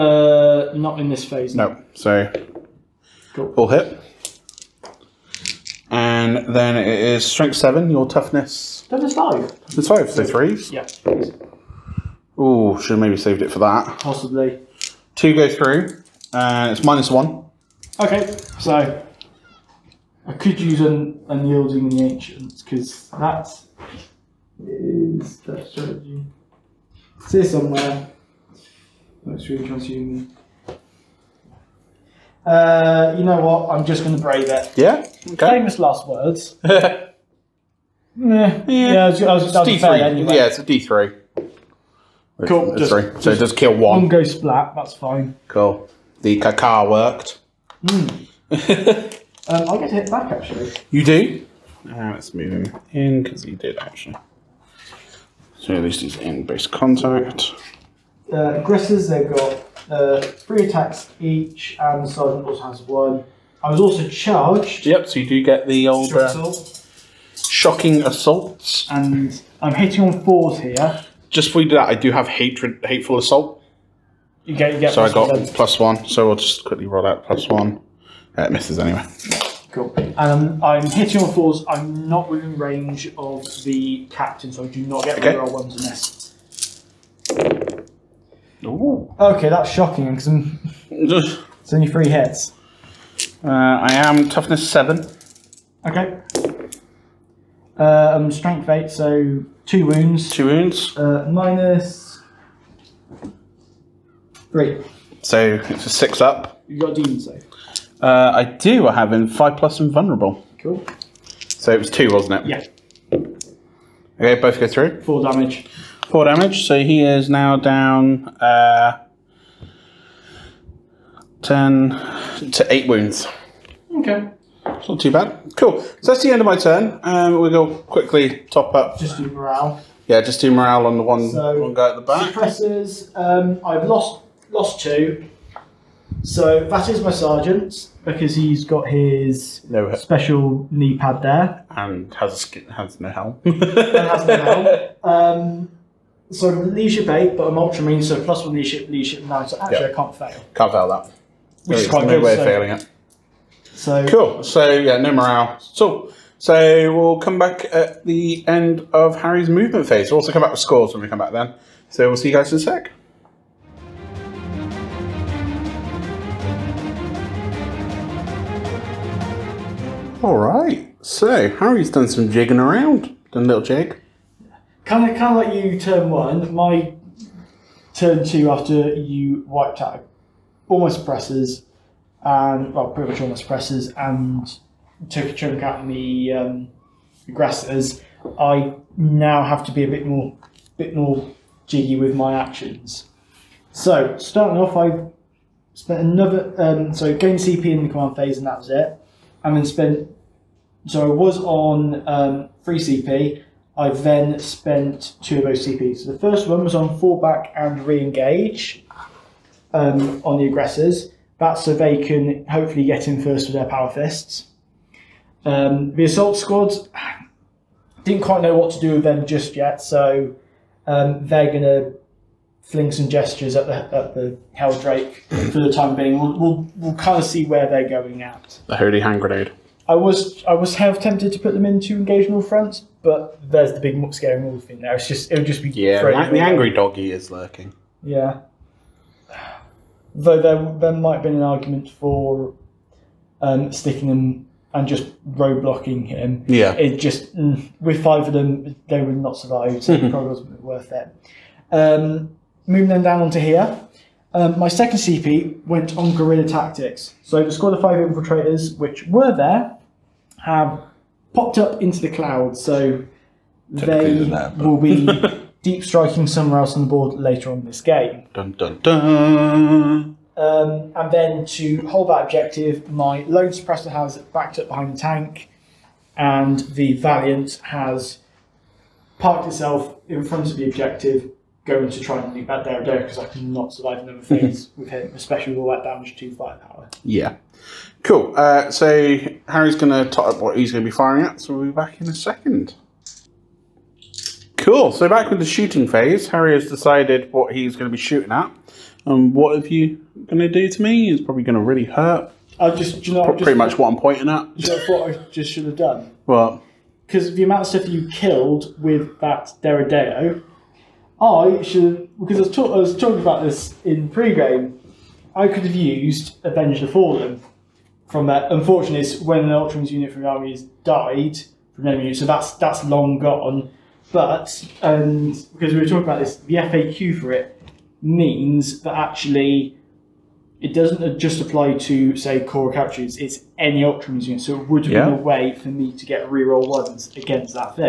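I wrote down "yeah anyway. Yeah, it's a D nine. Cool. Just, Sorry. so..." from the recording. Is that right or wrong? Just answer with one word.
wrong.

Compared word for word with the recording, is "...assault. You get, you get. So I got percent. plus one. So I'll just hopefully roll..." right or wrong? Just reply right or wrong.
wrong.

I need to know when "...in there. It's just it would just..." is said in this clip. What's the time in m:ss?
3:54.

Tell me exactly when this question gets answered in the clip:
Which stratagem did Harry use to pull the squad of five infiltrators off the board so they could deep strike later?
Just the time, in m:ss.
4:16.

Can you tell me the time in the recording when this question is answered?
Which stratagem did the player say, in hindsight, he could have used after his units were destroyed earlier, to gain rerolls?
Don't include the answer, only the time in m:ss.
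5:16.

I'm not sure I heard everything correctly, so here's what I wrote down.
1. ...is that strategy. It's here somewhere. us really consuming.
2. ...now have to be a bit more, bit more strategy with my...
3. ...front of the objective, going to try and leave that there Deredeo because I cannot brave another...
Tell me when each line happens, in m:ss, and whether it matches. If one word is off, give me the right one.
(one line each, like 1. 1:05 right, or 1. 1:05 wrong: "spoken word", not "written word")
1. 0:24 right
2. 3:08 wrong: "jiggy", not "strategy"
3. 4:40 wrong: "survive", not "brave".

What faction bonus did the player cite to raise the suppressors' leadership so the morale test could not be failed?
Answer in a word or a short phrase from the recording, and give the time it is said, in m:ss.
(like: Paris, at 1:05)
Ultramarine, at 2:27.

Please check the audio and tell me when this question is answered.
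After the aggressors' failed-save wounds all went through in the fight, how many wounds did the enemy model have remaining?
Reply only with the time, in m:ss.
2:01.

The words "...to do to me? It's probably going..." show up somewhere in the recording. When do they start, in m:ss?
5:00.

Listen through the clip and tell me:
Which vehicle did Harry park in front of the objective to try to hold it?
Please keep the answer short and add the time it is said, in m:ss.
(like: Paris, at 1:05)
Valiant, at 4:36.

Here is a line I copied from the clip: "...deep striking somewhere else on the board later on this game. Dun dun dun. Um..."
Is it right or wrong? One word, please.
right.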